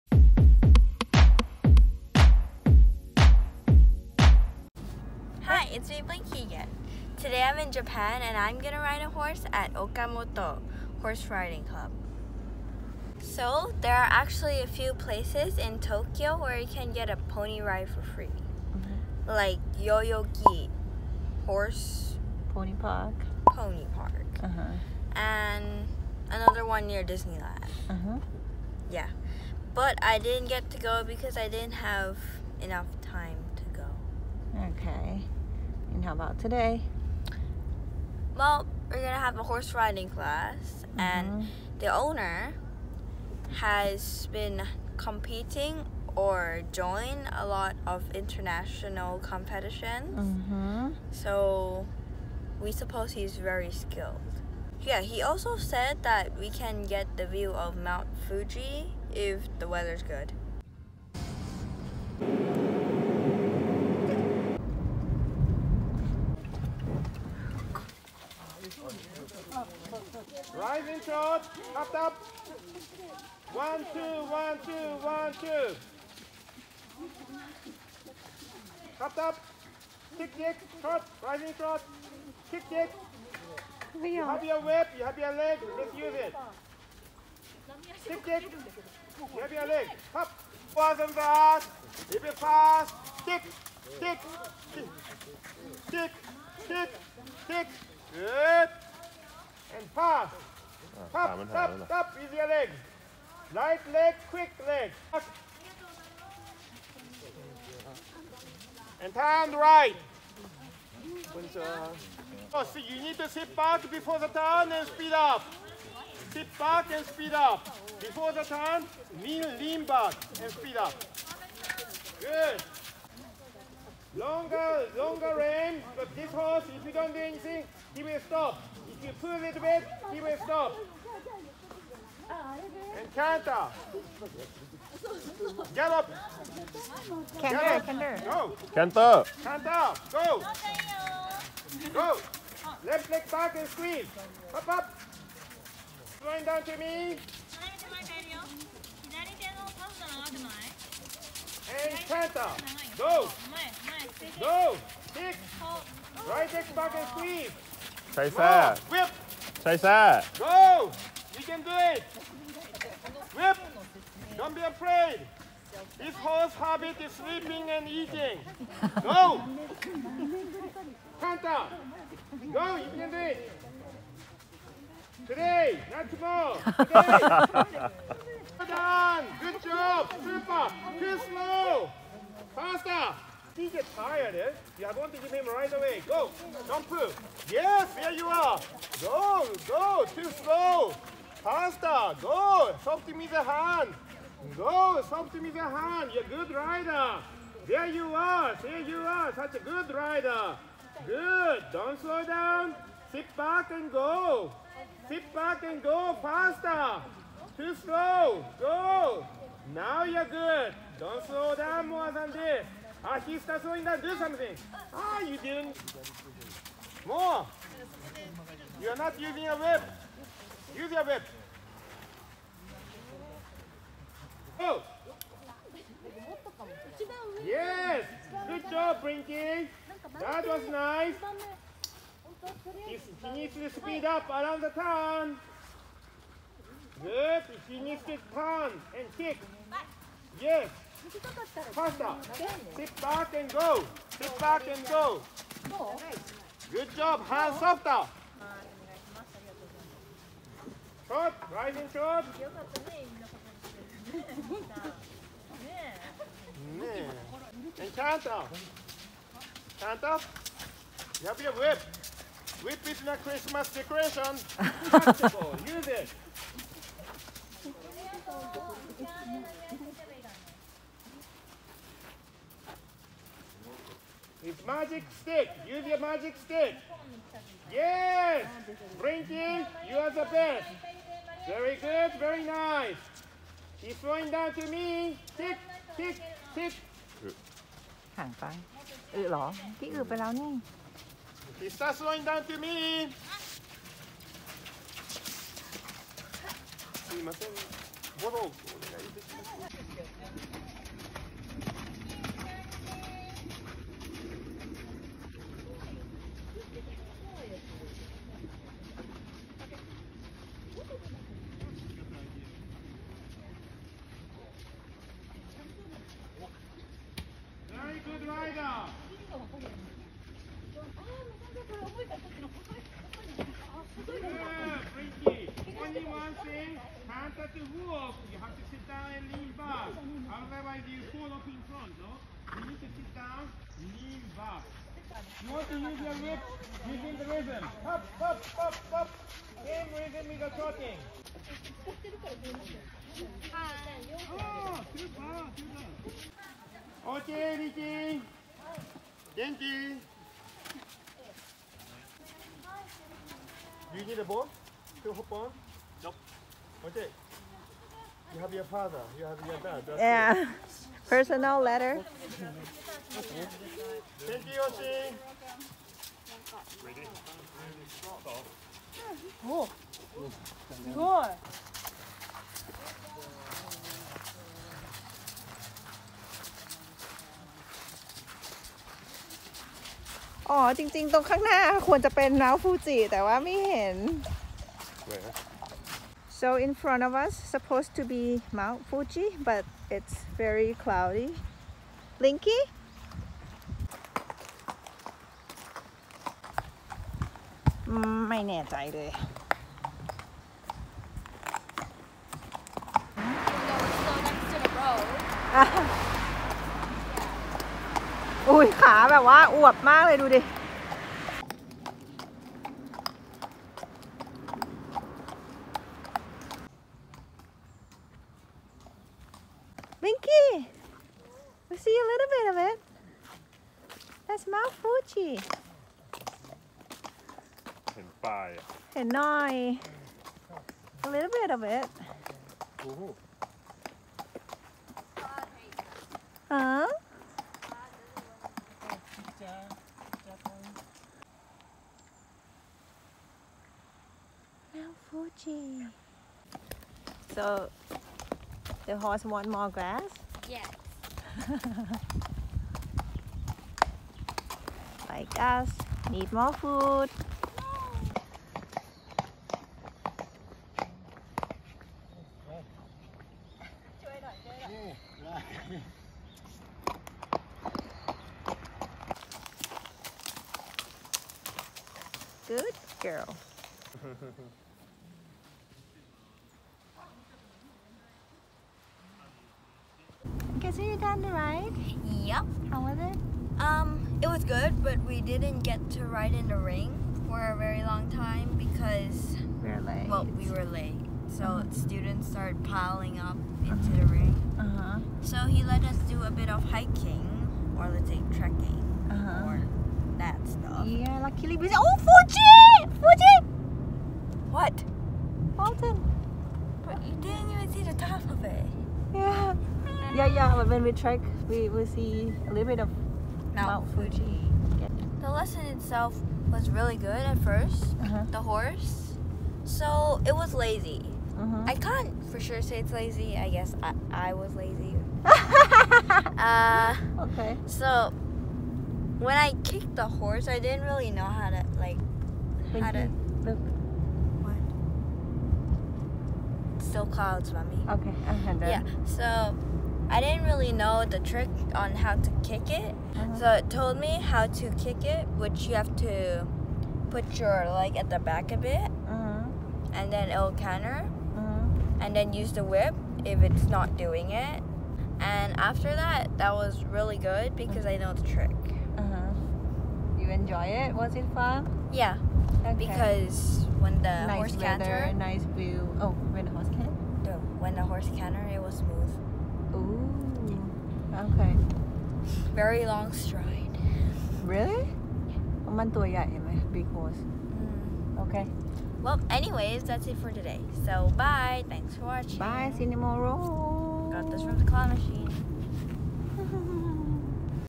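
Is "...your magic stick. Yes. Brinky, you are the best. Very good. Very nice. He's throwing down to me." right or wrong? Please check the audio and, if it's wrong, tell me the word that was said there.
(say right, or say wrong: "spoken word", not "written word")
right.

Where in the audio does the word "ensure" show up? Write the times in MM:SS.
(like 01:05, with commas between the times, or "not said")
not said.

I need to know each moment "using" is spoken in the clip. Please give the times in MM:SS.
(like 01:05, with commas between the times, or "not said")
03:39, 05:36.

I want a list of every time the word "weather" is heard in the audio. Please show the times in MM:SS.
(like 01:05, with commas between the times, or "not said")
00:59, 09:24.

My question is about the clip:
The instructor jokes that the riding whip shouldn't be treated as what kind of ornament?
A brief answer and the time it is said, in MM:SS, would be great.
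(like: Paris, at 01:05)
Christmas decoration, at 04:23.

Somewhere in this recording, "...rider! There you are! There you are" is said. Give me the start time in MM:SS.
03:16.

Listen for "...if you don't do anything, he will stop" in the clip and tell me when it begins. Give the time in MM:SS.
02:06.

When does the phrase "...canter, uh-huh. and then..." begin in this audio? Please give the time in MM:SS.
09:10.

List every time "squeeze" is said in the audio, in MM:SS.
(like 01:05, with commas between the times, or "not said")
02:23.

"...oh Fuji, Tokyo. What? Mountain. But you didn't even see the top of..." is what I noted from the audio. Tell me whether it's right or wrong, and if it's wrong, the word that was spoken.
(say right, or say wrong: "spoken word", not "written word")
wrong: "Fuji", not "Tokyo".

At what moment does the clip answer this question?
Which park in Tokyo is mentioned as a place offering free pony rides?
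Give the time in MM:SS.
00:19.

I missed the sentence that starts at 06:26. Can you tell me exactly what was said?
So in front of us, supposed to be Mount Fuji, but it's very cloudy.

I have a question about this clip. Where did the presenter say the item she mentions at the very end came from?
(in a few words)
claw machine.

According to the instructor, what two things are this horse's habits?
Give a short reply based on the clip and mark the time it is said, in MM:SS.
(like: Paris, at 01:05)
sleeping and eating, at 02:47.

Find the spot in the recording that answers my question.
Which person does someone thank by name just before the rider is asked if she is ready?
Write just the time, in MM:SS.
06:04.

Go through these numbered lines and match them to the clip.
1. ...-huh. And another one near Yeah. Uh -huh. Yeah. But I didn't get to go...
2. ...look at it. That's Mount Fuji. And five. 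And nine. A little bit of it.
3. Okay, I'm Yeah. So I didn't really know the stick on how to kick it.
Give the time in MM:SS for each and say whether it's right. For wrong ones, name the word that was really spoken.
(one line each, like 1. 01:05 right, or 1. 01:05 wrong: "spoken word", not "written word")
1. 00:24 wrong: "Disneyland", not "Yeah"
2. 07:02 right
3. 08:57 wrong: "trick", not "stick".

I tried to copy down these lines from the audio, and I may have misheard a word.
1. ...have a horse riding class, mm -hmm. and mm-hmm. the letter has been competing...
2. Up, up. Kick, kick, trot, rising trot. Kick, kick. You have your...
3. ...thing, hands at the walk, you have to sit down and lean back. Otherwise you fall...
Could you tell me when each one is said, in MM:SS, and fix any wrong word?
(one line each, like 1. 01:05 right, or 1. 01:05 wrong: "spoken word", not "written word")
1. 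00:39 wrong: "owner", not "letter"
2. 01:19 right
3. 05:26 right.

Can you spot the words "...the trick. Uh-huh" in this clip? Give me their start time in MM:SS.
09:18.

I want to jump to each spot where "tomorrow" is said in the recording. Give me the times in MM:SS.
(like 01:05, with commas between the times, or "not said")
02:56, 09:42.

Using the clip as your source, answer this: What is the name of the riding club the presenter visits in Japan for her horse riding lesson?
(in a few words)
Okamoto Horse Riding Club.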